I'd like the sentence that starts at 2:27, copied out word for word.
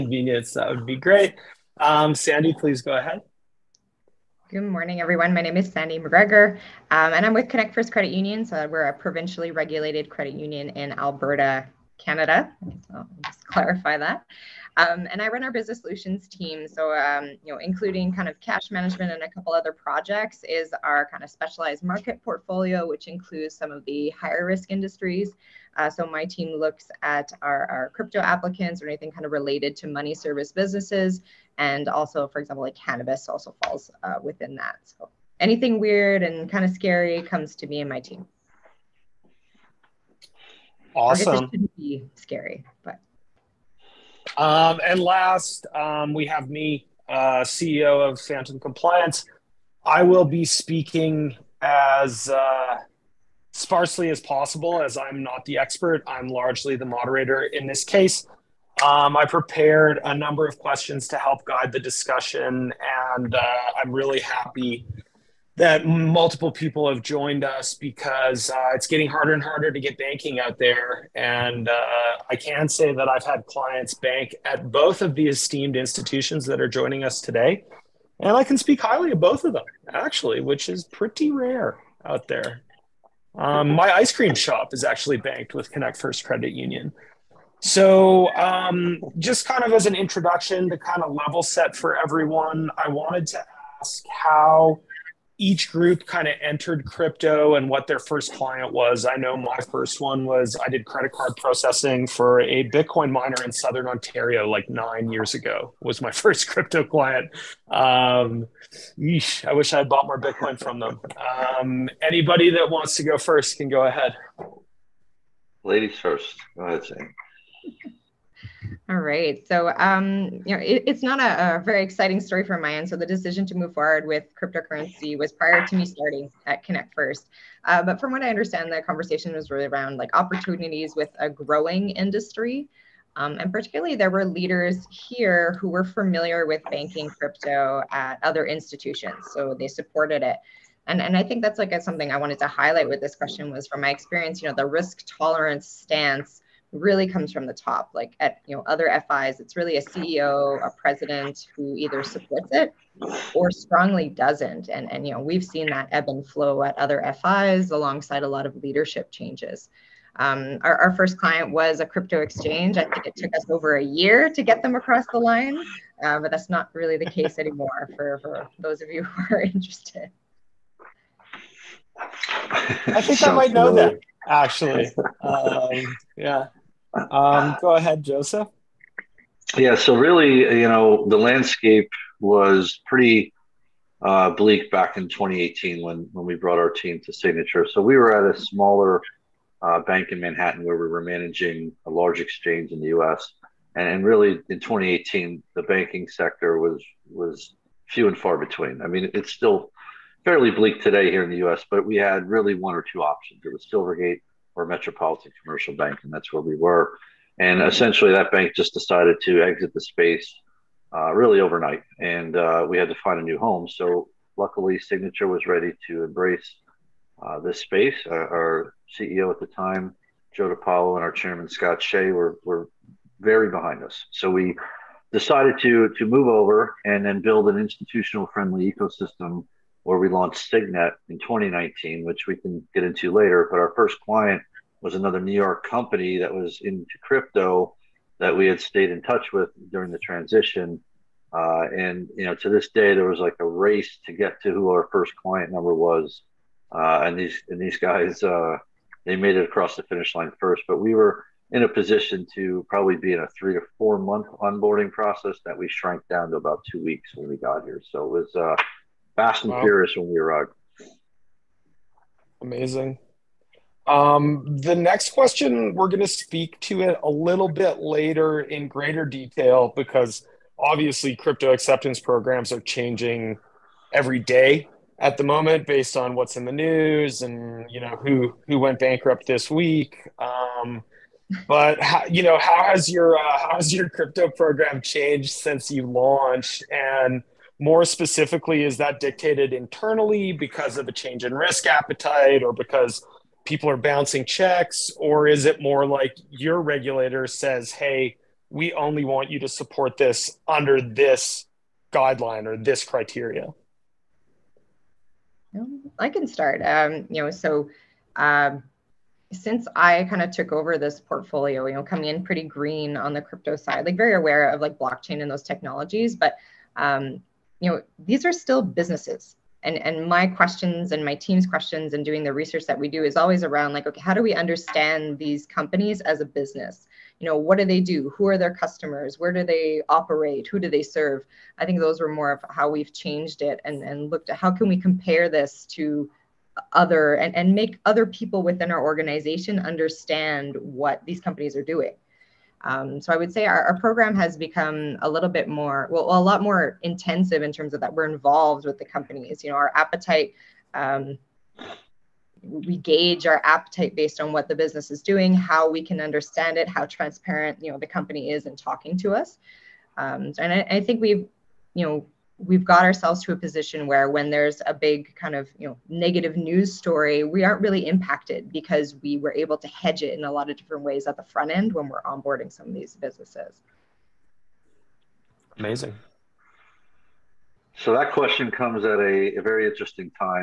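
Like at you know other FIs, it's really a CEO, a president who either supports it or strongly doesn't.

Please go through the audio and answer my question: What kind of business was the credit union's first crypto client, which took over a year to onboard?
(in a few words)
crypto exchange.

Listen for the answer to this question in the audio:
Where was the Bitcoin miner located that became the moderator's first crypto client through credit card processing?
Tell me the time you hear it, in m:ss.
1:43.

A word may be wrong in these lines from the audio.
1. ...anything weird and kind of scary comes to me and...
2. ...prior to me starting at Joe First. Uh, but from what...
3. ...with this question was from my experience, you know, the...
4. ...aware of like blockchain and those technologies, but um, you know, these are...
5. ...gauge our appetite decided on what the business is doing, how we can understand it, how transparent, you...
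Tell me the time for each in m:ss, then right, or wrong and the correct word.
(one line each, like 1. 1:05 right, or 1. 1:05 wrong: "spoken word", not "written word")
1. 0:35 right
2. 2:05 wrong: "Connect", not "Joe"
3. 2:22 right
4. 5:14 right
5. 5:52 wrong: "based", not "decided".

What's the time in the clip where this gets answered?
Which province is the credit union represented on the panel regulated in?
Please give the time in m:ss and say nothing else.
0:10.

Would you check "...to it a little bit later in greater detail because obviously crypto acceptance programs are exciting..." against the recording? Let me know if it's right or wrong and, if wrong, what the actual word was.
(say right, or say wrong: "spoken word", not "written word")
wrong: "changing", not "exciting".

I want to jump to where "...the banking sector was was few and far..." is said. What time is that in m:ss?
3:15.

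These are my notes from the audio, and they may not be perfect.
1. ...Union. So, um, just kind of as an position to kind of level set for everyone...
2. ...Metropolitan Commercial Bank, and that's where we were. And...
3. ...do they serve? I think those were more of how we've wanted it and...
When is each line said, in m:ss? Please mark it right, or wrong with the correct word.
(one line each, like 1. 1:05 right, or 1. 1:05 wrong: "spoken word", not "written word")
1. 1:26 wrong: "introduction", not "position"
2. 3:24 right
3. 5:30 wrong: "changed", not "wanted".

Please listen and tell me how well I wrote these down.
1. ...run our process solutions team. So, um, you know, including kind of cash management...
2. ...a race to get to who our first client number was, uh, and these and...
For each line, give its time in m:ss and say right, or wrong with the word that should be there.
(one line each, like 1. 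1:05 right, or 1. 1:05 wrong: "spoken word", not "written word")
1. 0:15 wrong: "business", not "process"
2. 4:03 right.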